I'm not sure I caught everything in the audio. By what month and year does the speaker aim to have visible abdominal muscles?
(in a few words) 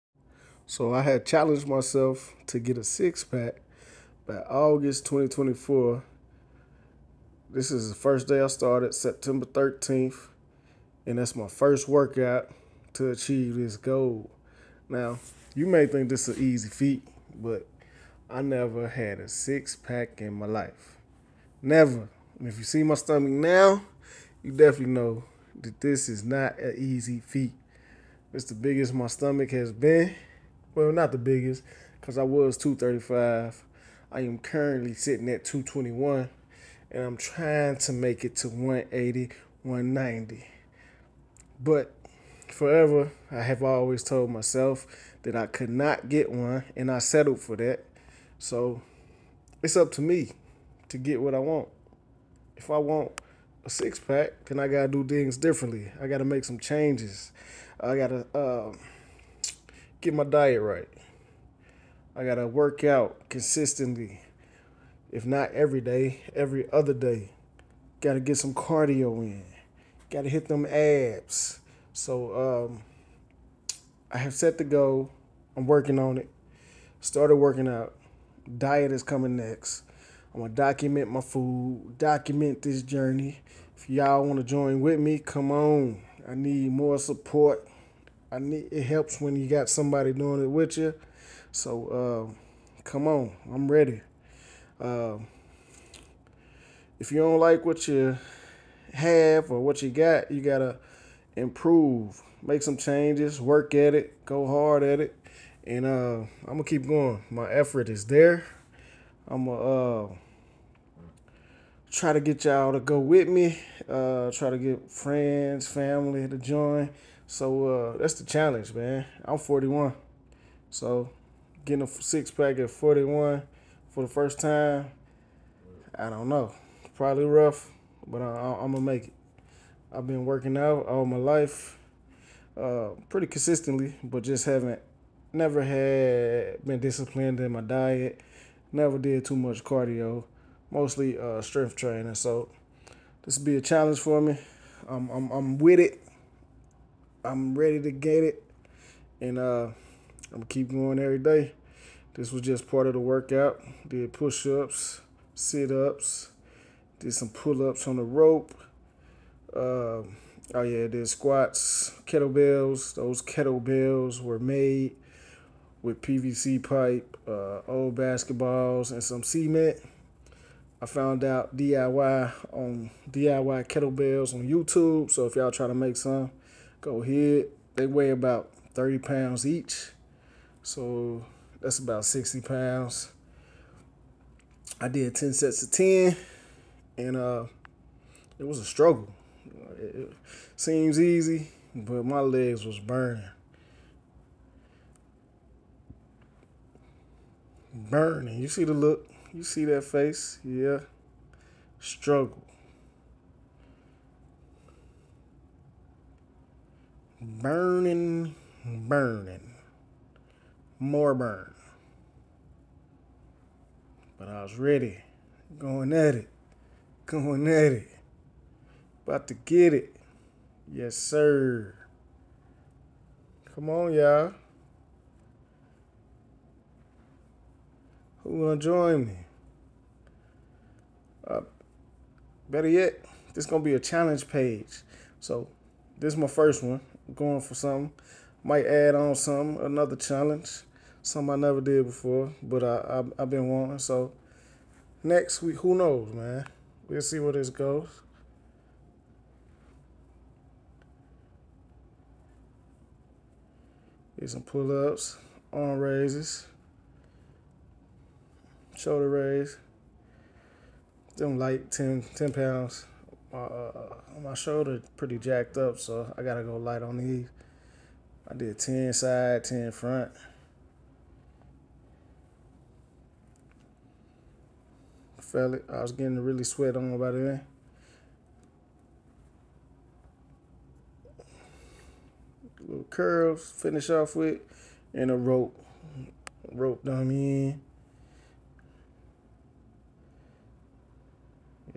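August 2024.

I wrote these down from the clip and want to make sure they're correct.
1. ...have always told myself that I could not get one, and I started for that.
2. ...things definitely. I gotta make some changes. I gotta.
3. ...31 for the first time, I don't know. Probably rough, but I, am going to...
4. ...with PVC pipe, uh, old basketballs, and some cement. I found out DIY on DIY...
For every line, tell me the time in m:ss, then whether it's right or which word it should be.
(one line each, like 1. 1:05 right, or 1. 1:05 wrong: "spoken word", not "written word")
1. 0:43 wrong: "settled", not "started"
2. 0:55 wrong: "differently", not "definitely"
3. 2:02 wrong: "41", not "31"
4. 2:45 right.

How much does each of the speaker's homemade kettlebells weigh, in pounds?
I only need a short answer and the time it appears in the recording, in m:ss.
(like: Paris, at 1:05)
30, at 2:58.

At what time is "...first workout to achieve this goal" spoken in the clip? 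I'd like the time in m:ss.
0:11.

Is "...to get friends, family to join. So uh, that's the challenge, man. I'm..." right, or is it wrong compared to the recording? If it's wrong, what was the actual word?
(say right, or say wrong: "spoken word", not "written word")
right.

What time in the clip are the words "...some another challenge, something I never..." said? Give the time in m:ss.
3:59.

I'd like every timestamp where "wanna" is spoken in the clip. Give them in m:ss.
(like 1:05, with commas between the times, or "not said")
1:24, 3:48.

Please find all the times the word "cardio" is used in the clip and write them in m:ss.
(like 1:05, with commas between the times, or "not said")
1:08, 2:19.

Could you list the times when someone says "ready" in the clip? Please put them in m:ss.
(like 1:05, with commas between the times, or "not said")
1:33, 2:27, 3:34.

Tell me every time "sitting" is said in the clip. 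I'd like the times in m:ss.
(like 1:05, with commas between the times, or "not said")
0:34.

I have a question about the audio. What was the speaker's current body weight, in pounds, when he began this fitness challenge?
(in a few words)
221.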